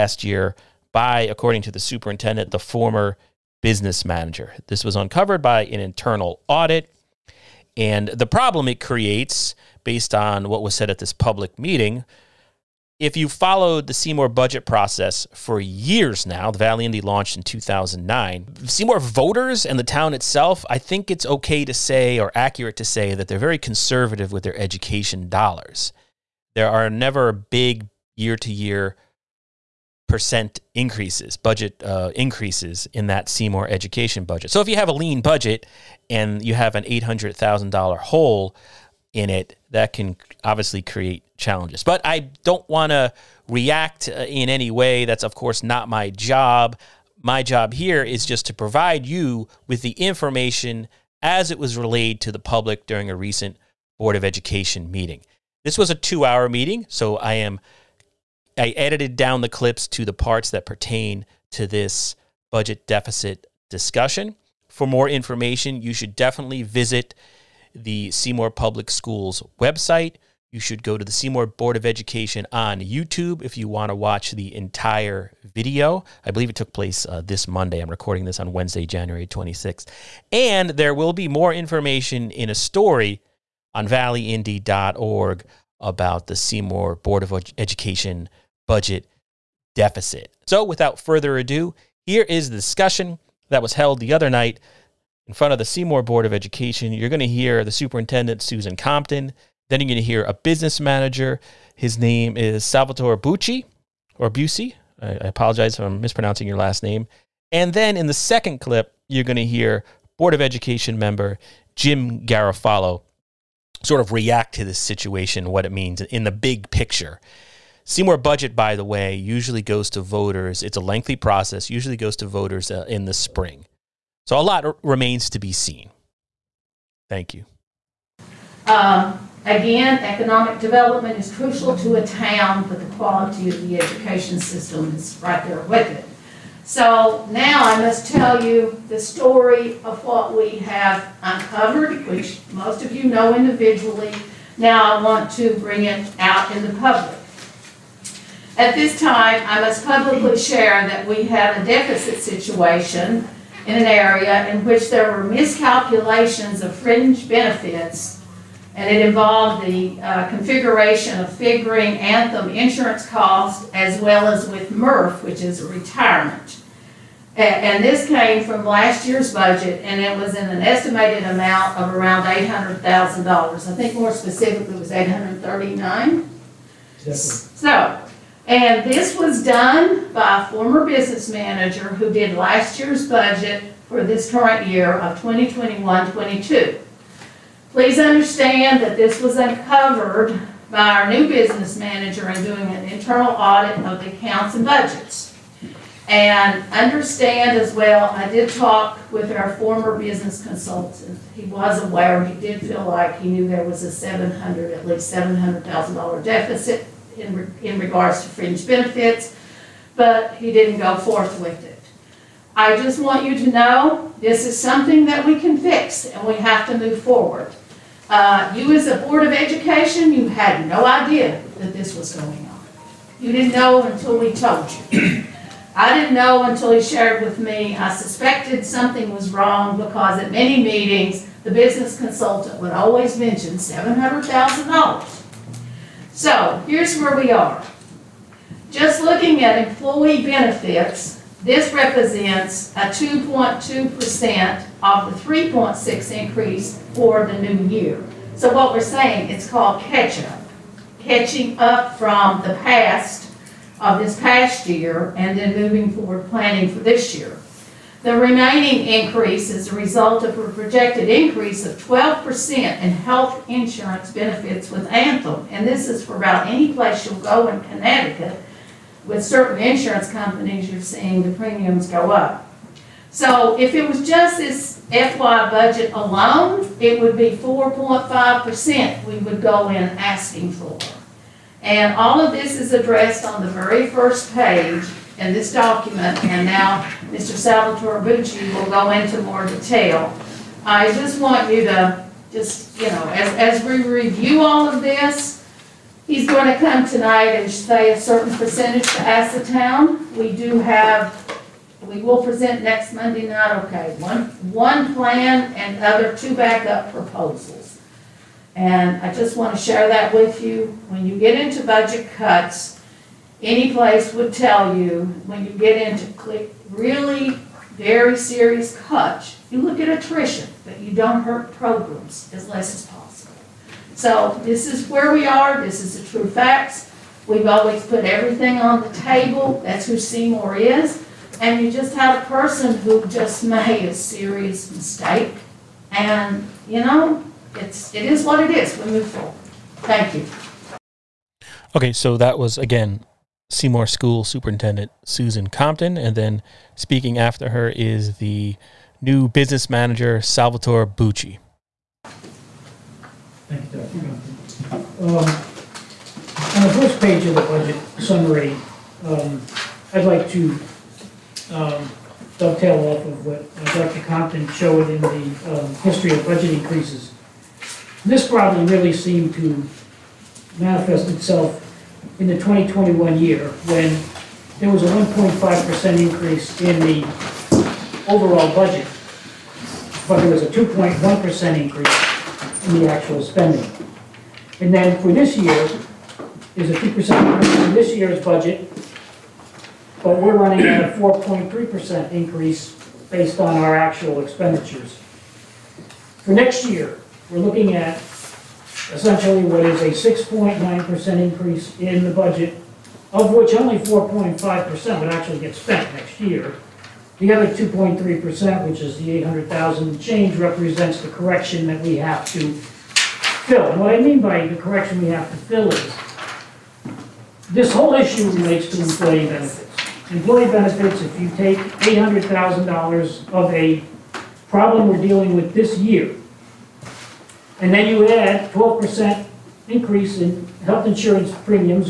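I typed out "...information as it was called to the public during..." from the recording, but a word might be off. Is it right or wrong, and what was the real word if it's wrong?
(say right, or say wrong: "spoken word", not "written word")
wrong: "relayed", not "called".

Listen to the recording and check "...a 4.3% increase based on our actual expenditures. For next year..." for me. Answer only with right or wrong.
right.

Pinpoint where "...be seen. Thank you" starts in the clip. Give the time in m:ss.
2:05.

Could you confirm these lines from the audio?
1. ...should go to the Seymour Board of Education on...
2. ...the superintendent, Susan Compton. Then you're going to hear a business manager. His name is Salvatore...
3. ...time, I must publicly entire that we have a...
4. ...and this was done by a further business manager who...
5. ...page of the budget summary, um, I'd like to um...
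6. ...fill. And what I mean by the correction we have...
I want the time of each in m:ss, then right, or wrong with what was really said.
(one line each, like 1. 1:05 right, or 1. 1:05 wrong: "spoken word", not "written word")
1. 1:10 right
2. 1:37 right
3. 2:29 wrong: "share", not "entire"
4. 2:58 wrong: "former", not "further"
5. 5:57 right
6. 6:52 right.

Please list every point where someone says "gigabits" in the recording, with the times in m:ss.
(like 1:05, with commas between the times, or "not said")
not said.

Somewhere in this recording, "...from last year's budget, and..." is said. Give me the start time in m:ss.
2:48.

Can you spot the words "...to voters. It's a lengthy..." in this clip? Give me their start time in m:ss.
1:59.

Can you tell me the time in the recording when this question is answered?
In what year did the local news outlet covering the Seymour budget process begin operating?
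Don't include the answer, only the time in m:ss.
0:17.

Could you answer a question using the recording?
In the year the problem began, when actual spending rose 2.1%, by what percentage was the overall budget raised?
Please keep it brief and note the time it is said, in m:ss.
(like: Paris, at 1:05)
1.5%, at 6:14.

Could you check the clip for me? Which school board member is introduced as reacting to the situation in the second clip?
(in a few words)
Jim Garofalo.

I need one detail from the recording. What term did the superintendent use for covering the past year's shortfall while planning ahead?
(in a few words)
catch-up.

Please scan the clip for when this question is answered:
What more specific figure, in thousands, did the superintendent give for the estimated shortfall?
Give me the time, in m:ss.
2:54.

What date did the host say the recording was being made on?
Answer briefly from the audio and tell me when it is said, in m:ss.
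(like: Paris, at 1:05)
Wednesday, January 26th, at 1:18.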